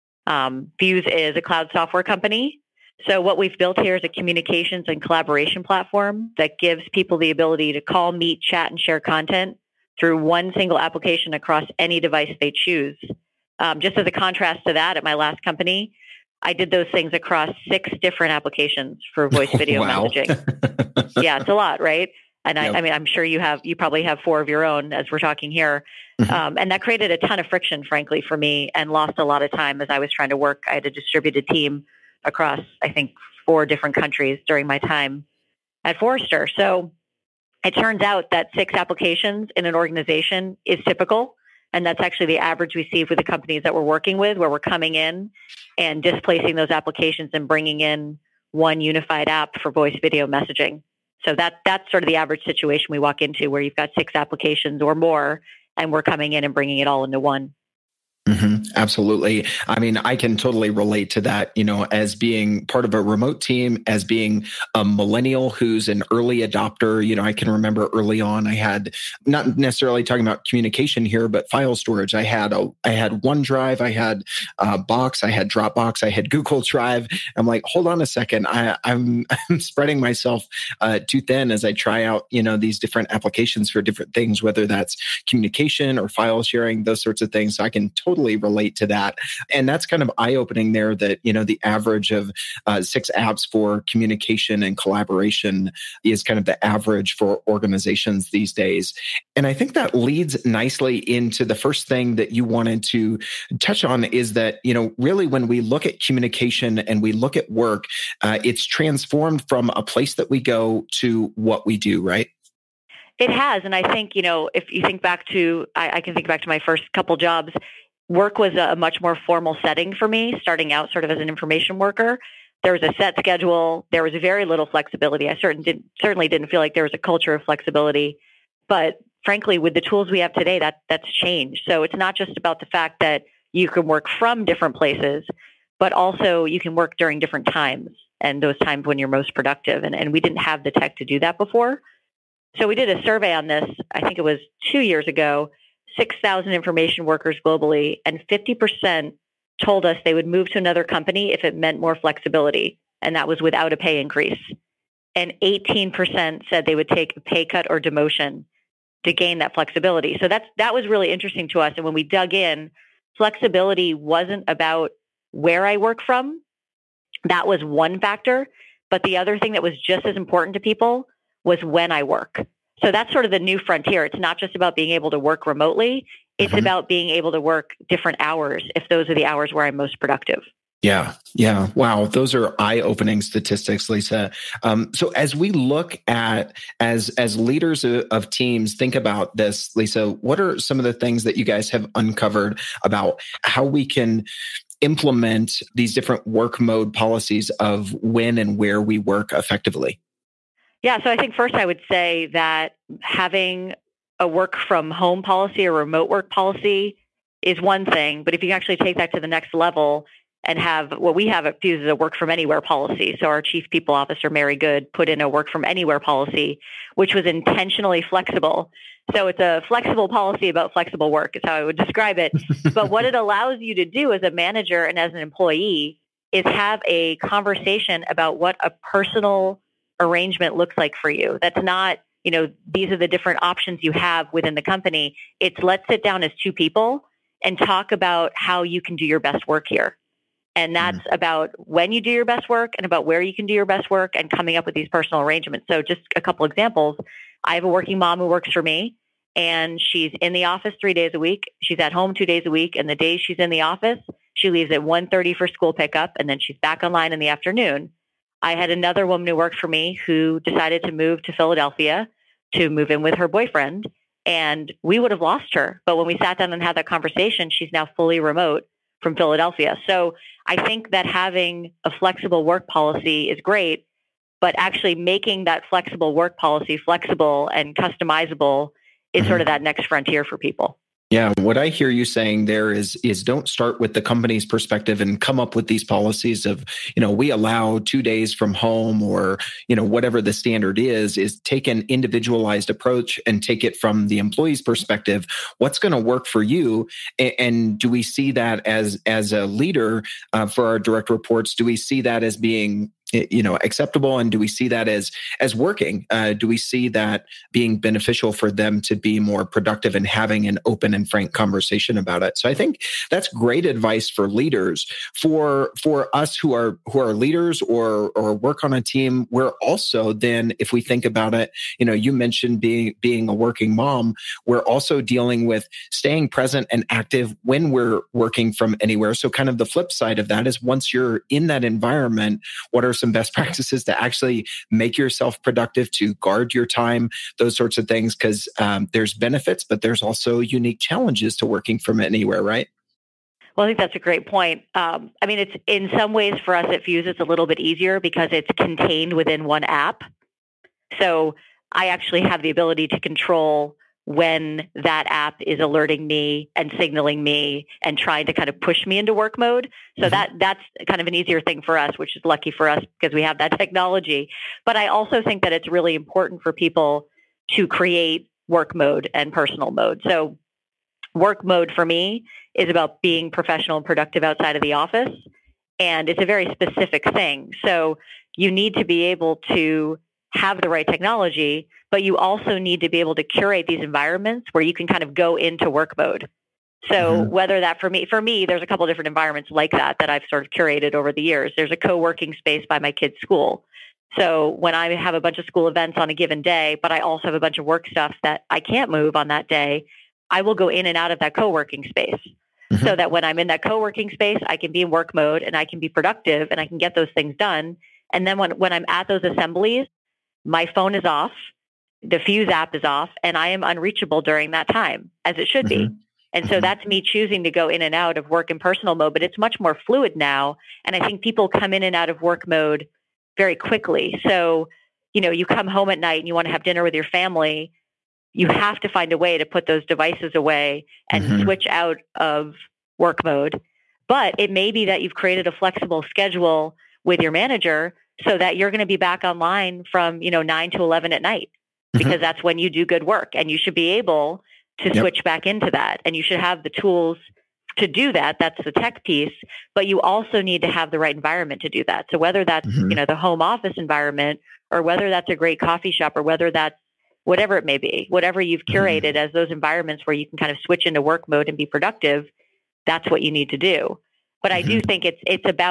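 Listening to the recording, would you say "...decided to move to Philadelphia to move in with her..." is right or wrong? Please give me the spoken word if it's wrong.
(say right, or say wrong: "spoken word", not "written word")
right.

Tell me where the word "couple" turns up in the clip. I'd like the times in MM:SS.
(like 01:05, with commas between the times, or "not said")
01:56, 04:06, 06:28.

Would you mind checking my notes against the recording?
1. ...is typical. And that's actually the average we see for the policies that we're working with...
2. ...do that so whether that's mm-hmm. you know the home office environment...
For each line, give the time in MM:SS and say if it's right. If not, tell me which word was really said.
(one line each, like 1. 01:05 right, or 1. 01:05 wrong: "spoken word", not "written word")
1. 00:40 wrong: "companies", not "policies"
2. 07:31 right.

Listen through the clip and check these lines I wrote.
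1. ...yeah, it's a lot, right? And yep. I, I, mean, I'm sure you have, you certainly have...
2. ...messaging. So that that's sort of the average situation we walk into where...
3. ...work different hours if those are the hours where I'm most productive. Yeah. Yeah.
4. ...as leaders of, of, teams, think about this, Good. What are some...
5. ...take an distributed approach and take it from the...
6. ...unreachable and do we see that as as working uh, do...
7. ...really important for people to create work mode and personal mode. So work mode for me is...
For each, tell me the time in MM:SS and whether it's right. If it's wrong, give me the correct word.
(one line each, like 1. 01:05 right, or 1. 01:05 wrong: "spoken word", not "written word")
1. 00:21 wrong: "probably", not "certainly"
2. 00:50 right
3. 02:57 right
4. 03:07 wrong: "Lisa", not "Good"
5. 04:51 wrong: "individualized", not "distributed"
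6. 05:03 wrong: "acceptable", not "unreachable"
7. 06:05 right.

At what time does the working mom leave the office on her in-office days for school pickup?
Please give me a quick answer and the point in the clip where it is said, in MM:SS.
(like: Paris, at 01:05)
1:30, at 04:14.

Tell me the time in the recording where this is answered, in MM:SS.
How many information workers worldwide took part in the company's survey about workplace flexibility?
02:25.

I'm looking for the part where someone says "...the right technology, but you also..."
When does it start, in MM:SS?
06:20.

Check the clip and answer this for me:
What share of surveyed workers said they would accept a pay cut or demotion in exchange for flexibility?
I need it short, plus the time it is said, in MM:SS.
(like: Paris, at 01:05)
18%, at 02:35.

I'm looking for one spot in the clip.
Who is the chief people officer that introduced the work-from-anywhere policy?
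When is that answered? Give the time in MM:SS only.
03:34.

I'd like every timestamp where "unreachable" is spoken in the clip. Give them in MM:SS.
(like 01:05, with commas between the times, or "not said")
06:53.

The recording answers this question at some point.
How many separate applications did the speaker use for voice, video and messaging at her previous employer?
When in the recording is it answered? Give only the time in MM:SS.
00:17.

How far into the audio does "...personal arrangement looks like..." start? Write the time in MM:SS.
03:48.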